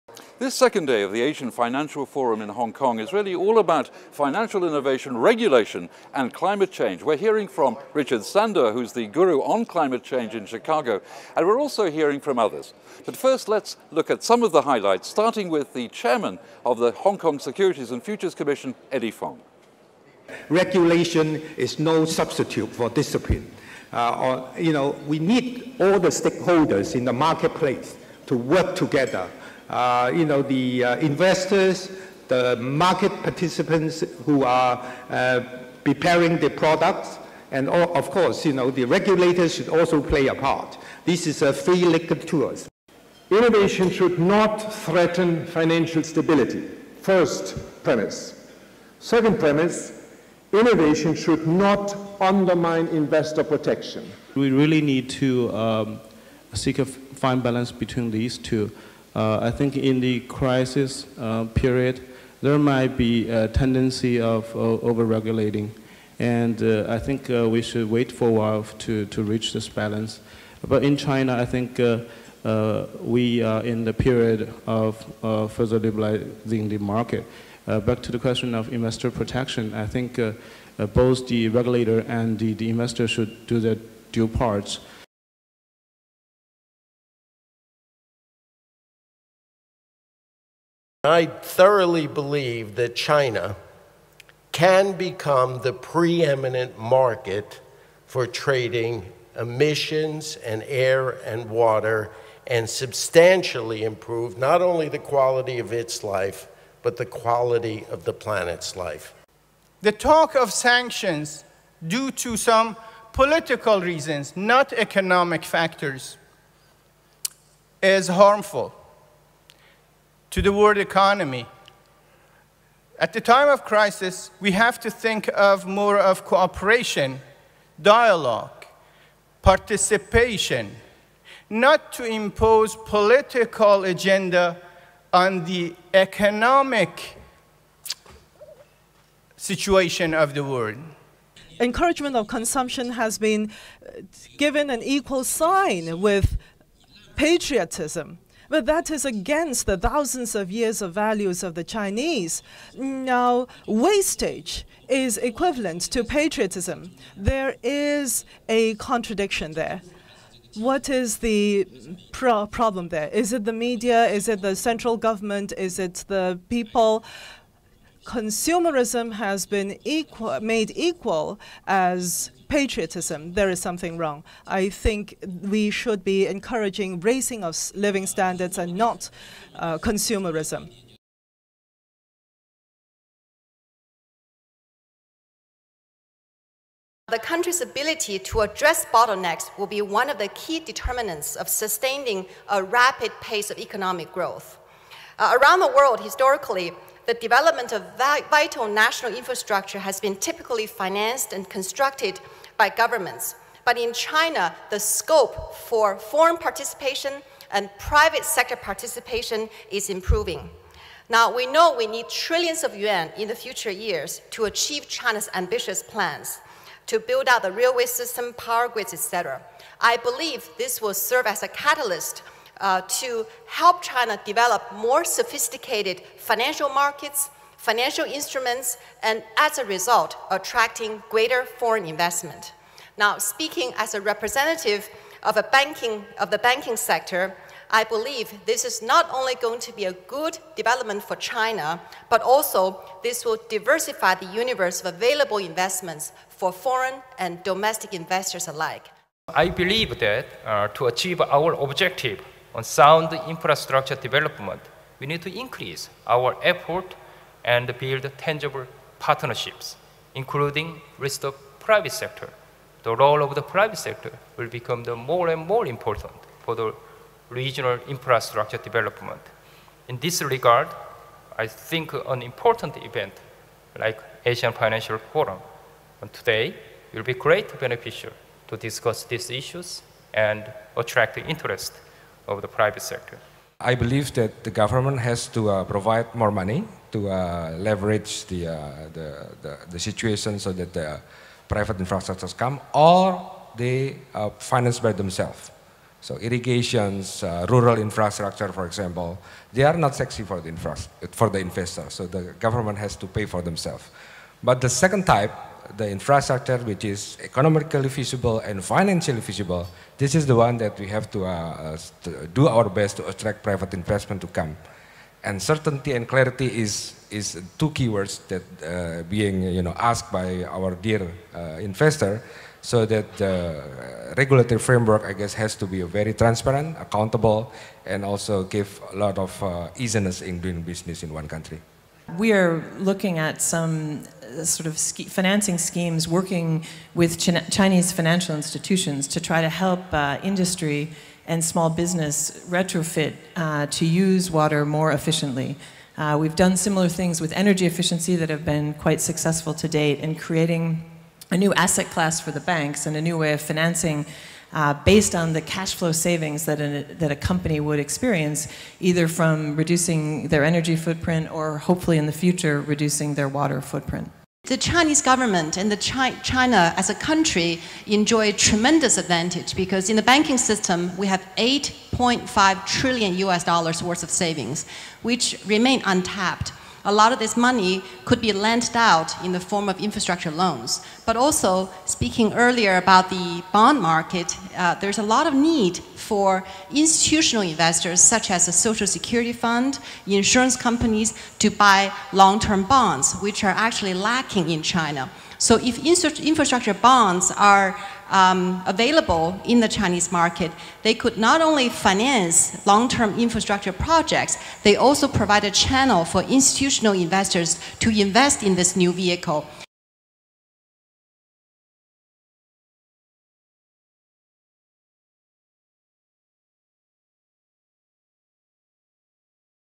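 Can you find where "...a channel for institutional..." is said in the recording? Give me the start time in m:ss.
6:45.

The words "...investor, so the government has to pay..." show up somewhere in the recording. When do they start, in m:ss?
5:01.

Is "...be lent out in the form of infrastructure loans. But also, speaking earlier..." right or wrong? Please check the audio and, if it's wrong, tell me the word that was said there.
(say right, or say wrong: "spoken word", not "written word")
right.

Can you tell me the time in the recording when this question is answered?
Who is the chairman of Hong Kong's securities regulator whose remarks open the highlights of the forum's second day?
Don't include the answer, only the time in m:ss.
0:18.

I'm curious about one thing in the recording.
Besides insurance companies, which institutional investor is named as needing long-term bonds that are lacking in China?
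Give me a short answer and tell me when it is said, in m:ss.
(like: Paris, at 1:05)
social security fund, at 6:28.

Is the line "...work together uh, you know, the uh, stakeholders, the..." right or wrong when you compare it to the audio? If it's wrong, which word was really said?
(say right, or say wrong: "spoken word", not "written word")
wrong: "investors", not "stakeholders".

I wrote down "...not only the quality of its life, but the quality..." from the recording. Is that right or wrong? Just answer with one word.
right.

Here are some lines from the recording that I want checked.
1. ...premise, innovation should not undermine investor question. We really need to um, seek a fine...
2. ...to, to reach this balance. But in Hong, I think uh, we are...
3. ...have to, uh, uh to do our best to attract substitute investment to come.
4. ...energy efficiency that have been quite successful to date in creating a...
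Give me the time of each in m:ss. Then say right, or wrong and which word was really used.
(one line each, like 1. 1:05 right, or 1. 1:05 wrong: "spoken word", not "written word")
1. 0:49 wrong: "protection", not "question"
2. 1:08 wrong: "China", not "Hong"
3. 5:10 wrong: "private", not "substitute"
4. 5:47 right.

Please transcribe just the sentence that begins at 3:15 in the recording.
Uh, around the world, historically, the development of vital national infrastructure has been typically financed and constructed by governments.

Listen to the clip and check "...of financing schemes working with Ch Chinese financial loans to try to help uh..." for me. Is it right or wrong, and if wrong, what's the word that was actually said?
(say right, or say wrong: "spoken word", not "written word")
wrong: "institutions", not "loans".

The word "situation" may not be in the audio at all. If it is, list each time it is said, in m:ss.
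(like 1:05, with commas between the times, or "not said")
2:19, 4:49.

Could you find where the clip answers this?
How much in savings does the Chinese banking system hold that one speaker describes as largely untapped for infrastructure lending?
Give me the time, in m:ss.
6:11.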